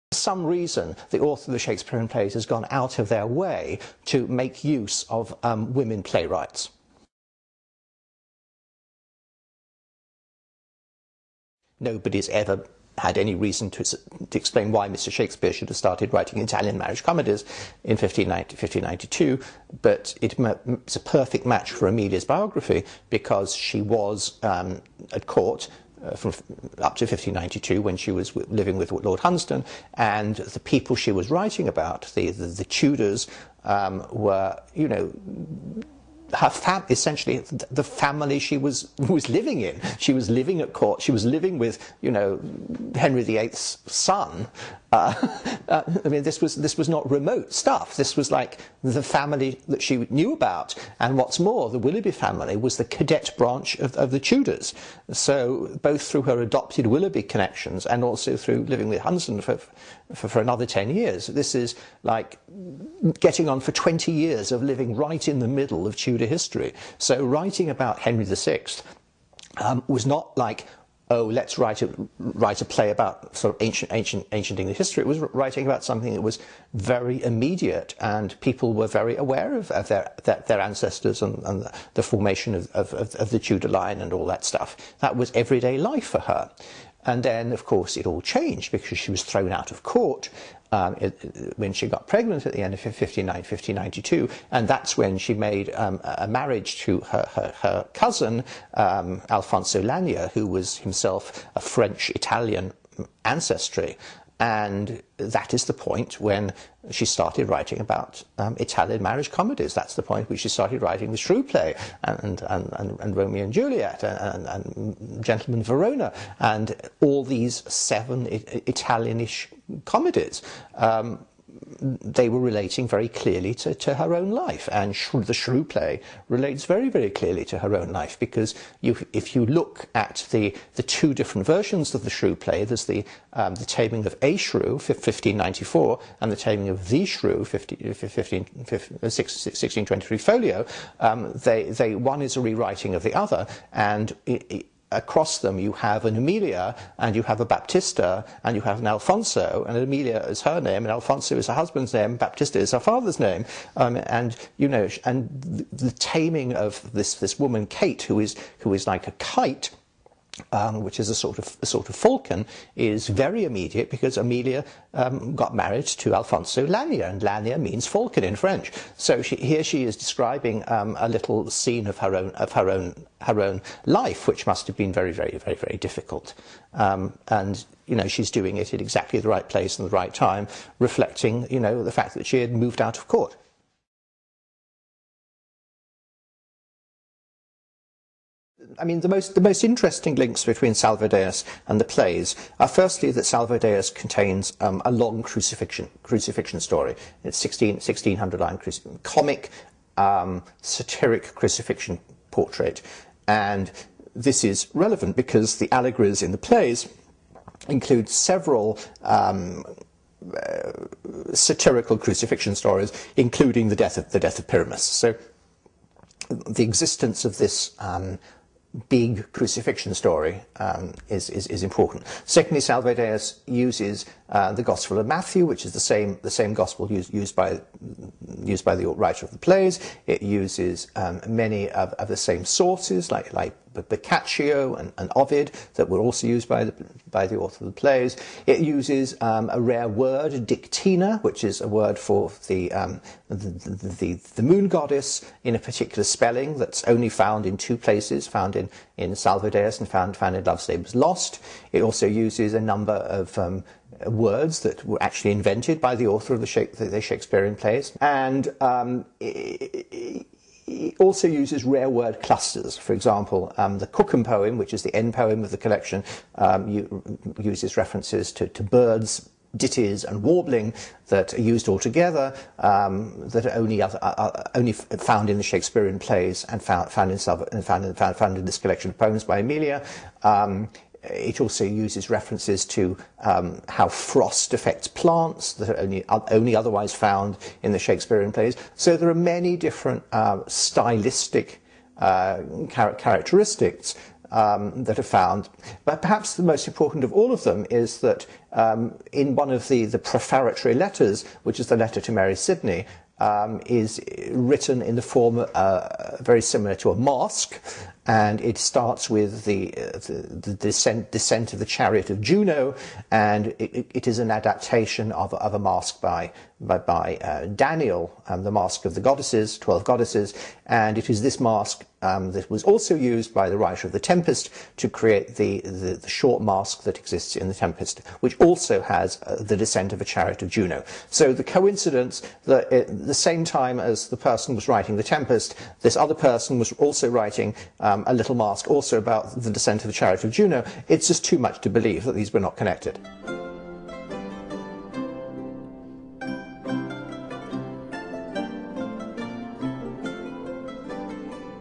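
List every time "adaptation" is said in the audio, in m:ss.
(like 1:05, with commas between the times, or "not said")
5:14.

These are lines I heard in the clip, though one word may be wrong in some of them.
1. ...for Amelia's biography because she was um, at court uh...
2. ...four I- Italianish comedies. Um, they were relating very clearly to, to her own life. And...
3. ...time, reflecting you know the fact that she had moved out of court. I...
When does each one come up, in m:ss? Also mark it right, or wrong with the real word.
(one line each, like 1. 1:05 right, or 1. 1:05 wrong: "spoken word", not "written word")
1. 0:21 right
2. 1:57 wrong: "seven", not "four"
3. 3:00 right.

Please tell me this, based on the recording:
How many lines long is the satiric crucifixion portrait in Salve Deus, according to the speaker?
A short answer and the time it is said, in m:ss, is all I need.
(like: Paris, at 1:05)
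1600, at 3:17.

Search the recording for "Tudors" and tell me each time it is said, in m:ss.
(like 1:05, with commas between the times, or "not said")
0:32, 0:54, 1:05, 1:23.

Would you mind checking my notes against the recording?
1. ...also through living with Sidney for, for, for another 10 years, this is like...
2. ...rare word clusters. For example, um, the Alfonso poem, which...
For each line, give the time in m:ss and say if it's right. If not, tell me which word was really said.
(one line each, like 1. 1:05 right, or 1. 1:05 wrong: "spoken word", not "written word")
1. 0:58 wrong: "Hunsdon", not "Sidney"
2. 4:21 wrong: "Cookham", not "Alfonso".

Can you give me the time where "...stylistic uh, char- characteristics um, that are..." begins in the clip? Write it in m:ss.
4:50.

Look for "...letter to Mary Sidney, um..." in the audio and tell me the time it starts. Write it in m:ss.
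5:01.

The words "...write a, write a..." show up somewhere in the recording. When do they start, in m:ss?
1:11.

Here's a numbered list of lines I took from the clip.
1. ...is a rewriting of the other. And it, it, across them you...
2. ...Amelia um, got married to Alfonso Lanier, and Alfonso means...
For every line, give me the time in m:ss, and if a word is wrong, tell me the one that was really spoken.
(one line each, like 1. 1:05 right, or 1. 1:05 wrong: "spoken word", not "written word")
1. 2:22 right
2. 2:44 wrong: "Lanier", not "Alfonso".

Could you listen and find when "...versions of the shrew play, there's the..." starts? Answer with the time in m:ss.
2:11.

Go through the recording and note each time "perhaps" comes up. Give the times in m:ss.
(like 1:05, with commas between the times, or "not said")
4:56.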